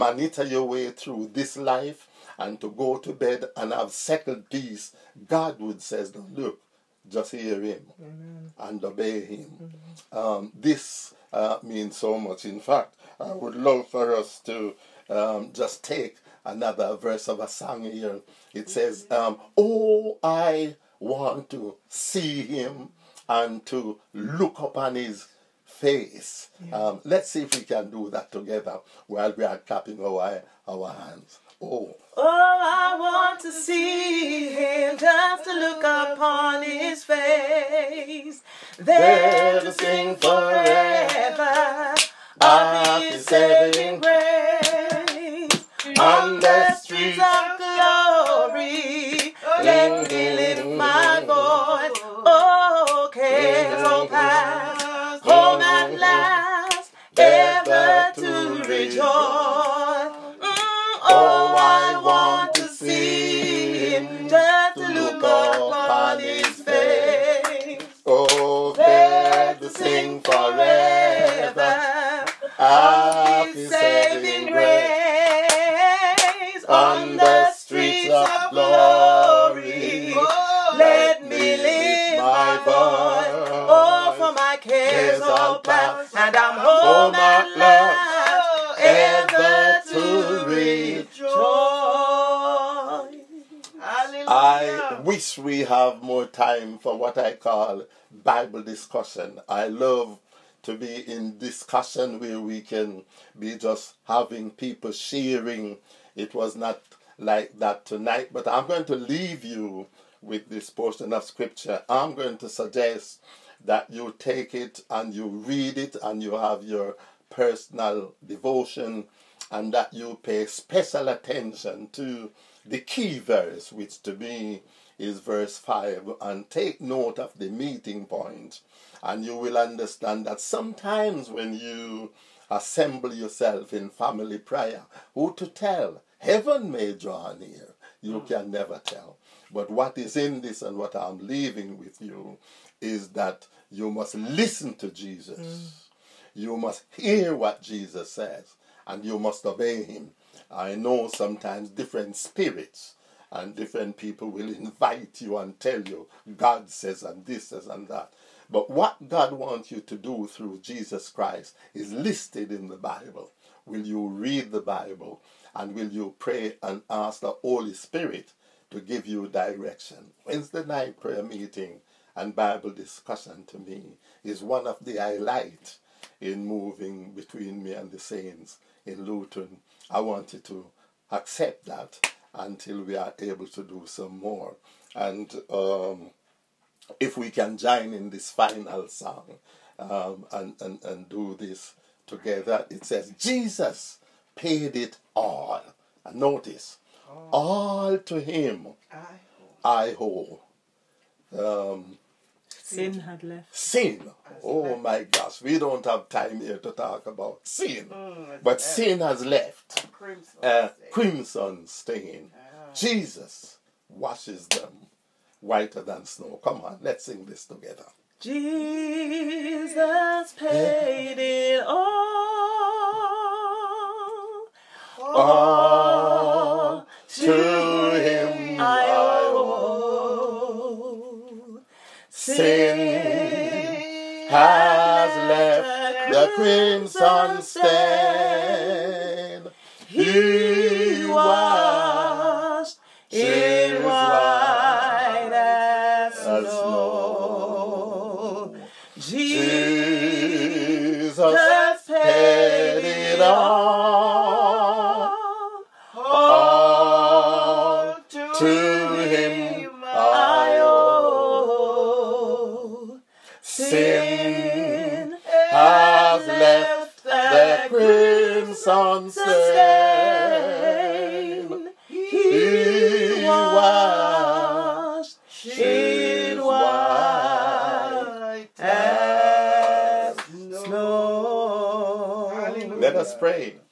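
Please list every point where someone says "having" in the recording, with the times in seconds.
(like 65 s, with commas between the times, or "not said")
104 s.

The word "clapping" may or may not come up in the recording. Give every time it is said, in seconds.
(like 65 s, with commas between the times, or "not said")
29 s.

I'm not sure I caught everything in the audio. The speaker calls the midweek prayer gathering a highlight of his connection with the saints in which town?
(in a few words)
Luton.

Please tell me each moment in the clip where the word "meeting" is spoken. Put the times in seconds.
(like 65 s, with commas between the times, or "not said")
127 s, 171 s.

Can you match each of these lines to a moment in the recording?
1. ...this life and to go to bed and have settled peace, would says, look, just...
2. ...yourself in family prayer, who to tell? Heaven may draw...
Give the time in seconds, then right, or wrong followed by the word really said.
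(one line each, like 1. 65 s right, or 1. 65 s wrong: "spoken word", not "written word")
1. 1 s right
2. 133 s right.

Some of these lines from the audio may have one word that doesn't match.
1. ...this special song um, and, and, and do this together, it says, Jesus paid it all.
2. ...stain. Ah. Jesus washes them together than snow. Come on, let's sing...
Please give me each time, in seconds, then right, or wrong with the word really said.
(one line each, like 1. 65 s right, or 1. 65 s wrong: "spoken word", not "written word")
1. 188 s wrong: "final", not "special"
2. 211 s wrong: "whiter", not "together".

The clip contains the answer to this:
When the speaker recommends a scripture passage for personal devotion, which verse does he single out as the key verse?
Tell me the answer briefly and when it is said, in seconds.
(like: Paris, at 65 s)
Verse 5, at 125 s.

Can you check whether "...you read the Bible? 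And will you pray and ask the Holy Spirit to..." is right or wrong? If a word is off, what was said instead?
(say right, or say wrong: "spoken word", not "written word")
right.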